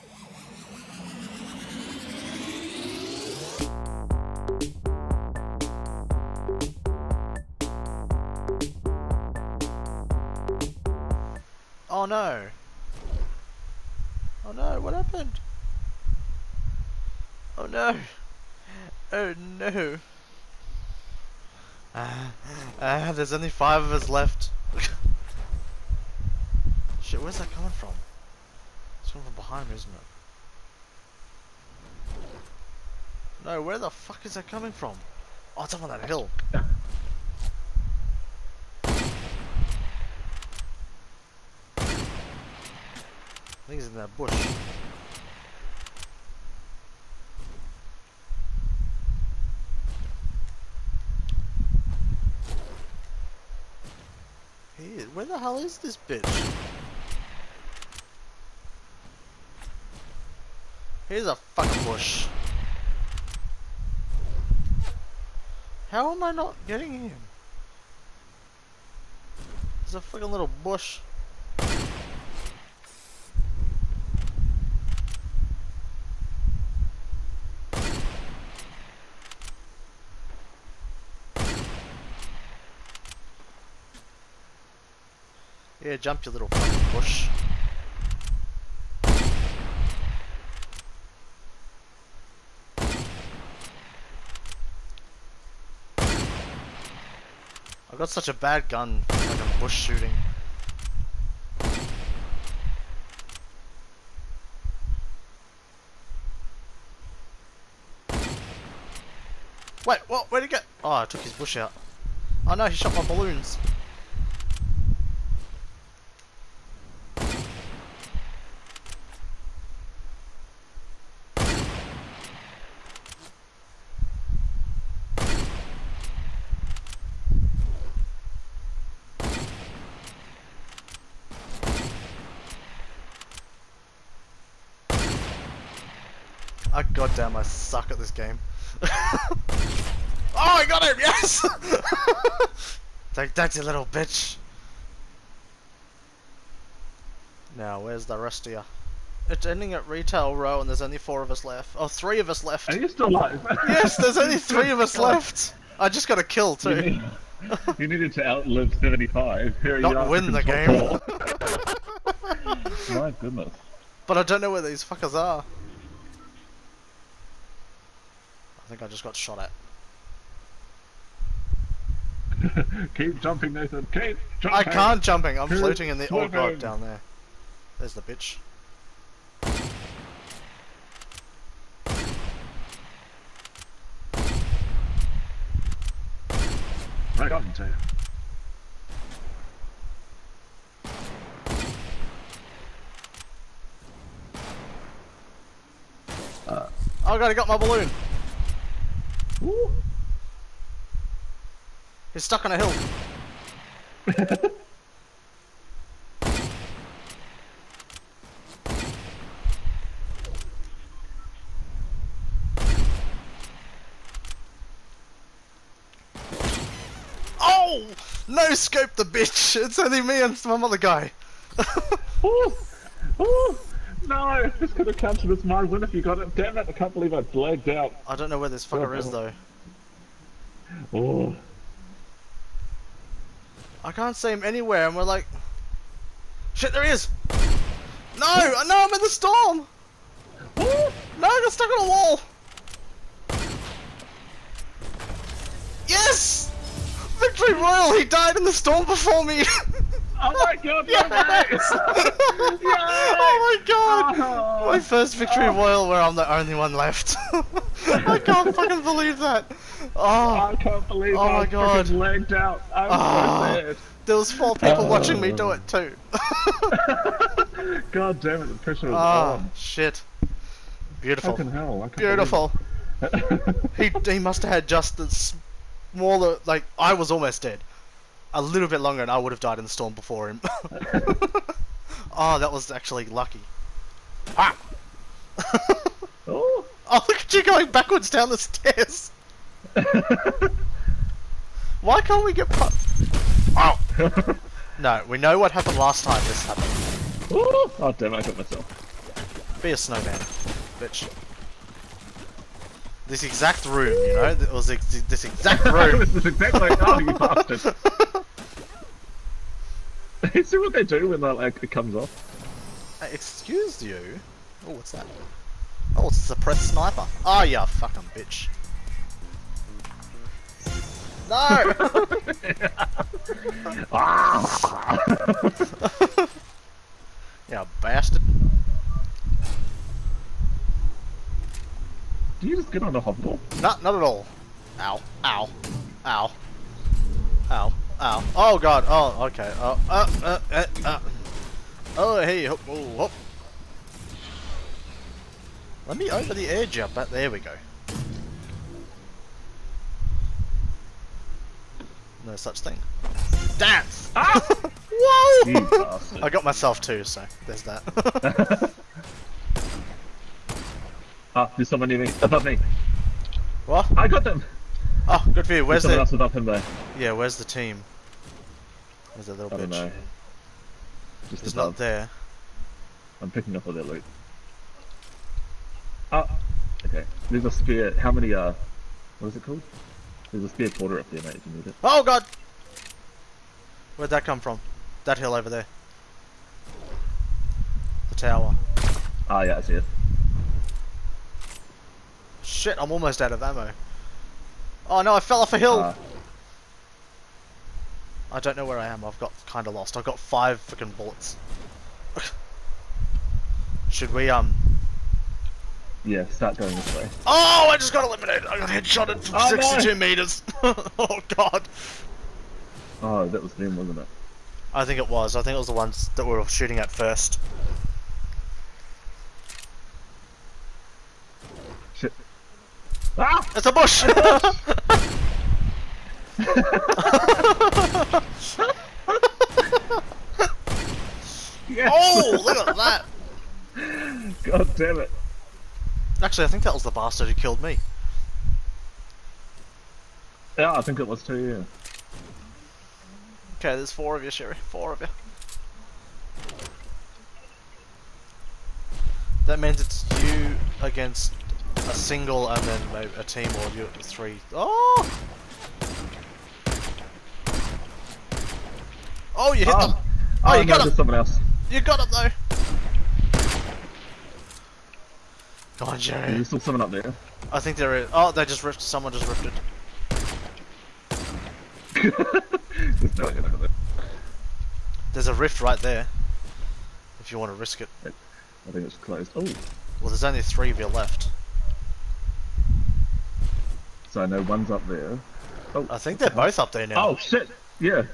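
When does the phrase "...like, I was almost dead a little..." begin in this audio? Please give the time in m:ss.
4:36.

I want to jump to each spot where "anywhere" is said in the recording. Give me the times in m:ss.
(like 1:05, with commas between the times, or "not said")
3:54.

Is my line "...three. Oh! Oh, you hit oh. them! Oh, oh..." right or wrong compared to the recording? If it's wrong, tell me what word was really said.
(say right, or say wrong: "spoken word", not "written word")
right.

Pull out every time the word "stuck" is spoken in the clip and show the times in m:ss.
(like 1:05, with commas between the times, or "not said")
3:22, 4:01.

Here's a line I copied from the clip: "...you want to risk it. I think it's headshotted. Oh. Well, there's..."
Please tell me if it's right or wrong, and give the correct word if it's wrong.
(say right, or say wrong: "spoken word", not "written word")
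wrong: "closed", not "headshotted".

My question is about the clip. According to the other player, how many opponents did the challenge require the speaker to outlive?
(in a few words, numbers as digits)
75.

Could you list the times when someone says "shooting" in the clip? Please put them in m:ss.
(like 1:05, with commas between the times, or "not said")
1:39, 6:56.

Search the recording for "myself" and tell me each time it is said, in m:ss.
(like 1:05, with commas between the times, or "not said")
4:58, 5:56.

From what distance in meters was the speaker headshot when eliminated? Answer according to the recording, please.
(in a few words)
62.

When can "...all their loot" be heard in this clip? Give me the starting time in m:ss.
6:13.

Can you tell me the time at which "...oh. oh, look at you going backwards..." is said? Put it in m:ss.
4:46.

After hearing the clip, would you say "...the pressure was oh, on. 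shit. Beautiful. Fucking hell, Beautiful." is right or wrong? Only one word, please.
right.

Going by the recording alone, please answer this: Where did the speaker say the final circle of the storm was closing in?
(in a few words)
Retail Row.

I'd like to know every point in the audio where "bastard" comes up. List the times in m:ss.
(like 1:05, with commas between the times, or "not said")
5:07, 5:27, 7:16.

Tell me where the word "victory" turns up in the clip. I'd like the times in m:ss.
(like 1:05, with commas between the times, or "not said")
4:07, 4:15.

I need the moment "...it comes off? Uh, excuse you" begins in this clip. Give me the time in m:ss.
5:11.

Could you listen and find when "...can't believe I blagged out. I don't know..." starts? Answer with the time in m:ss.
3:46.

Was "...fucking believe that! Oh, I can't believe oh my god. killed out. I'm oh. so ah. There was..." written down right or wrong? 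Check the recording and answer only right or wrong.
wrong.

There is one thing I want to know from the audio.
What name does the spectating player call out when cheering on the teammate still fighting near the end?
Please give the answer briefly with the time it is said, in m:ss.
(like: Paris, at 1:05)
Jerry, at 7:45.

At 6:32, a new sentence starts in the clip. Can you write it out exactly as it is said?
Shit, I'm almost out of ammo.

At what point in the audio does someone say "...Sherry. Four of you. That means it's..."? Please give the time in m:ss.
7:24.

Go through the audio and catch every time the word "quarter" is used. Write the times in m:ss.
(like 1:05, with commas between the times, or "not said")
6:20.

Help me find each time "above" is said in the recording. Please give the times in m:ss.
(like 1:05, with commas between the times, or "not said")
6:02, 6:11.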